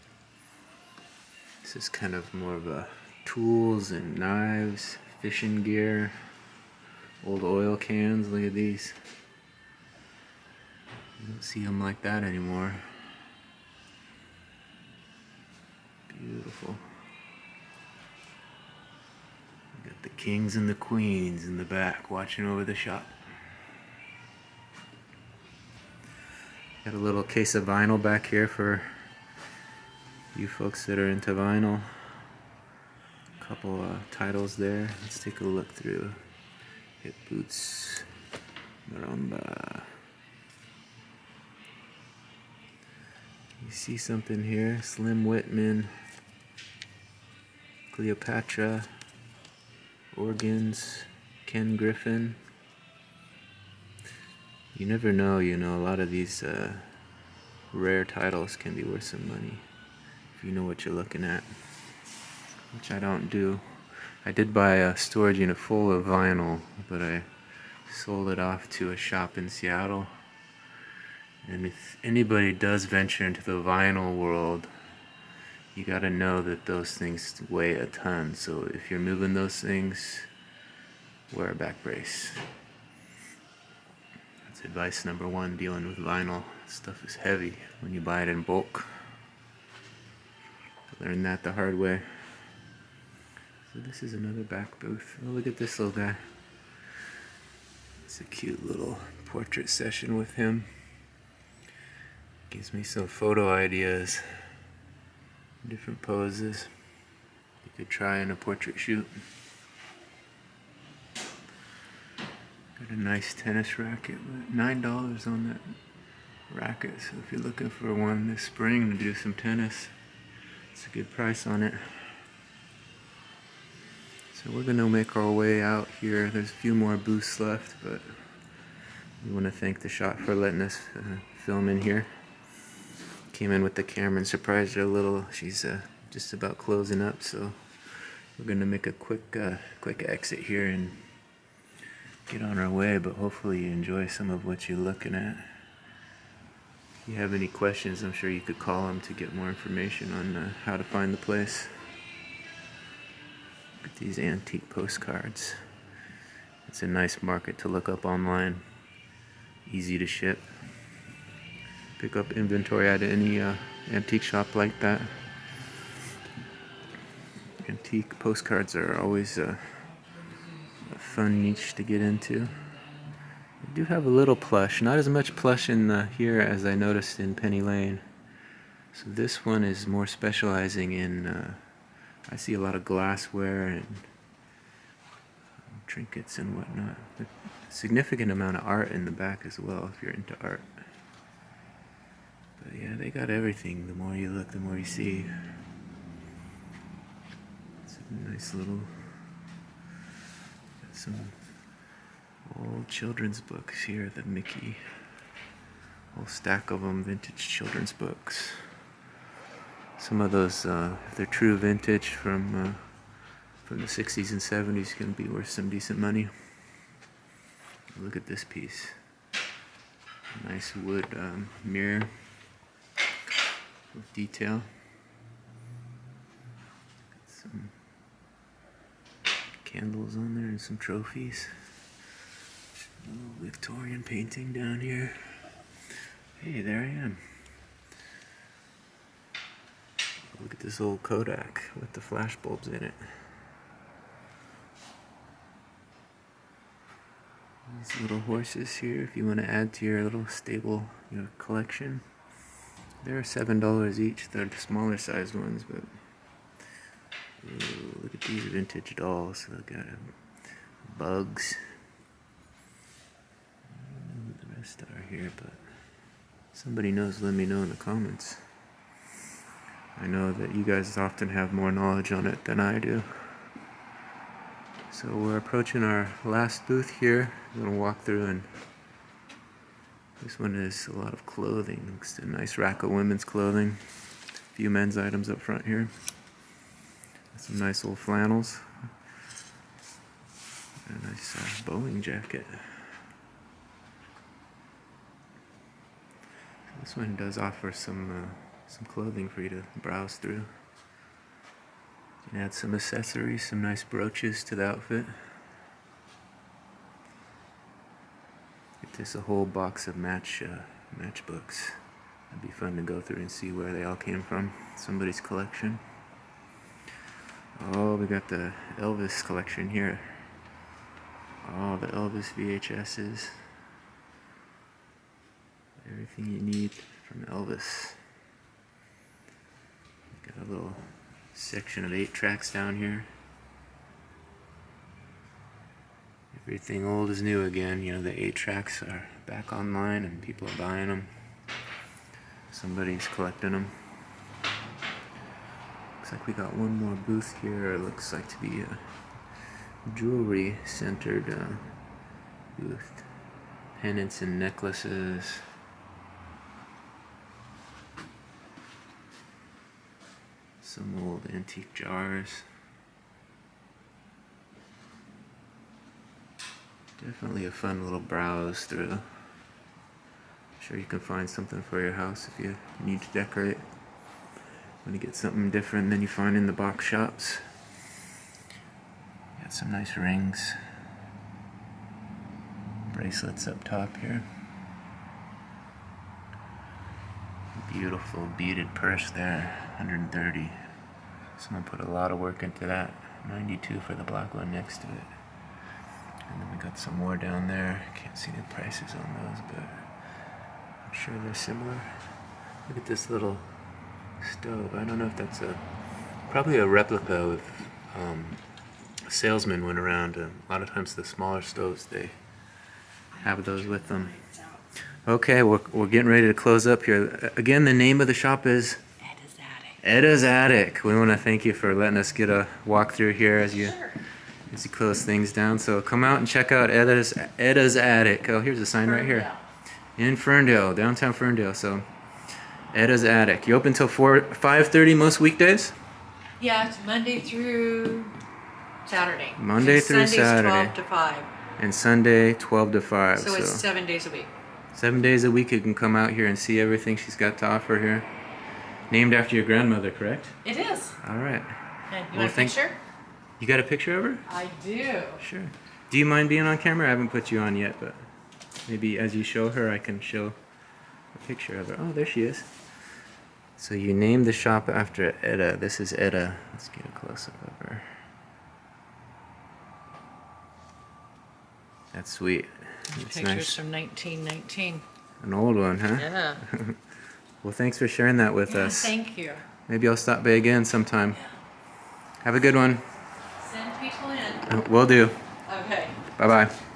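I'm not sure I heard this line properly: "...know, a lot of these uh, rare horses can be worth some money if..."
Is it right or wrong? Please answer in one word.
wrong.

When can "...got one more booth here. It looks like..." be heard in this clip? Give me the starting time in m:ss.
5:46.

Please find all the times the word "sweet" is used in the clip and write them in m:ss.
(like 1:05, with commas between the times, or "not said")
7:52.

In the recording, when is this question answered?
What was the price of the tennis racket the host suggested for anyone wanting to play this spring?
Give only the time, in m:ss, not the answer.
1:54.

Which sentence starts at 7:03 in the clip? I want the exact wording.
Sure as he closes things down.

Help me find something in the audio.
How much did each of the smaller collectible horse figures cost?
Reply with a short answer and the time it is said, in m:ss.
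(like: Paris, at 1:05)
$7, at 4:13.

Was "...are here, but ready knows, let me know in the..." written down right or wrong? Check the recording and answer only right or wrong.
wrong.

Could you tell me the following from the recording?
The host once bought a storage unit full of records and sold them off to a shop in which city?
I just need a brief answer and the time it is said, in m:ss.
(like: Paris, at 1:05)
Seattle, at 1:09.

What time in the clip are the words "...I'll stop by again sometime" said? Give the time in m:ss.
7:59.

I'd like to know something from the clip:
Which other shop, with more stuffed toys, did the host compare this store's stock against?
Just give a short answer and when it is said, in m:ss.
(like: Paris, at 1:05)
Penny Lane, at 2:57.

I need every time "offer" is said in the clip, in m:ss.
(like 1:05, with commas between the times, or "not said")
4:57, 7:27.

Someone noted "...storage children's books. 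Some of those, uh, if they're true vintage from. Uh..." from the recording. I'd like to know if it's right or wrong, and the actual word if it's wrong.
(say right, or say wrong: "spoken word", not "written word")
wrong: "vintage", not "storage".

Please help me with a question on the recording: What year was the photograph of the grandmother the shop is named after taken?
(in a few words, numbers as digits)
1919.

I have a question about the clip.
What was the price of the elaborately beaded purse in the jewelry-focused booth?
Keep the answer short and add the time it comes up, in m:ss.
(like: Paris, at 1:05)
130, at 6:29.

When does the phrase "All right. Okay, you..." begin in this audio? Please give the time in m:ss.
7:31.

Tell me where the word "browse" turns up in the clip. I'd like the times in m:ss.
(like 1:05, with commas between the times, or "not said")
4:59, 6:08.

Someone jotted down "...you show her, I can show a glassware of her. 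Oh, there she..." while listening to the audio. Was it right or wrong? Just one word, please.
wrong.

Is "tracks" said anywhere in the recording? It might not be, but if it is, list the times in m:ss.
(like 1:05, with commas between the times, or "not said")
5:32, 5:38.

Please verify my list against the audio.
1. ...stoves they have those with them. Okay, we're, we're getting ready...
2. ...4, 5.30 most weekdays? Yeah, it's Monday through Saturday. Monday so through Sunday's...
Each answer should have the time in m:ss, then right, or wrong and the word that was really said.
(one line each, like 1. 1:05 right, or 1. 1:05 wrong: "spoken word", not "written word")
1. 6:51 right
2. 7:13 right.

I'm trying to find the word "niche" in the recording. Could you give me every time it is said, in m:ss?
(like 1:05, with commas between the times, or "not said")
2:51.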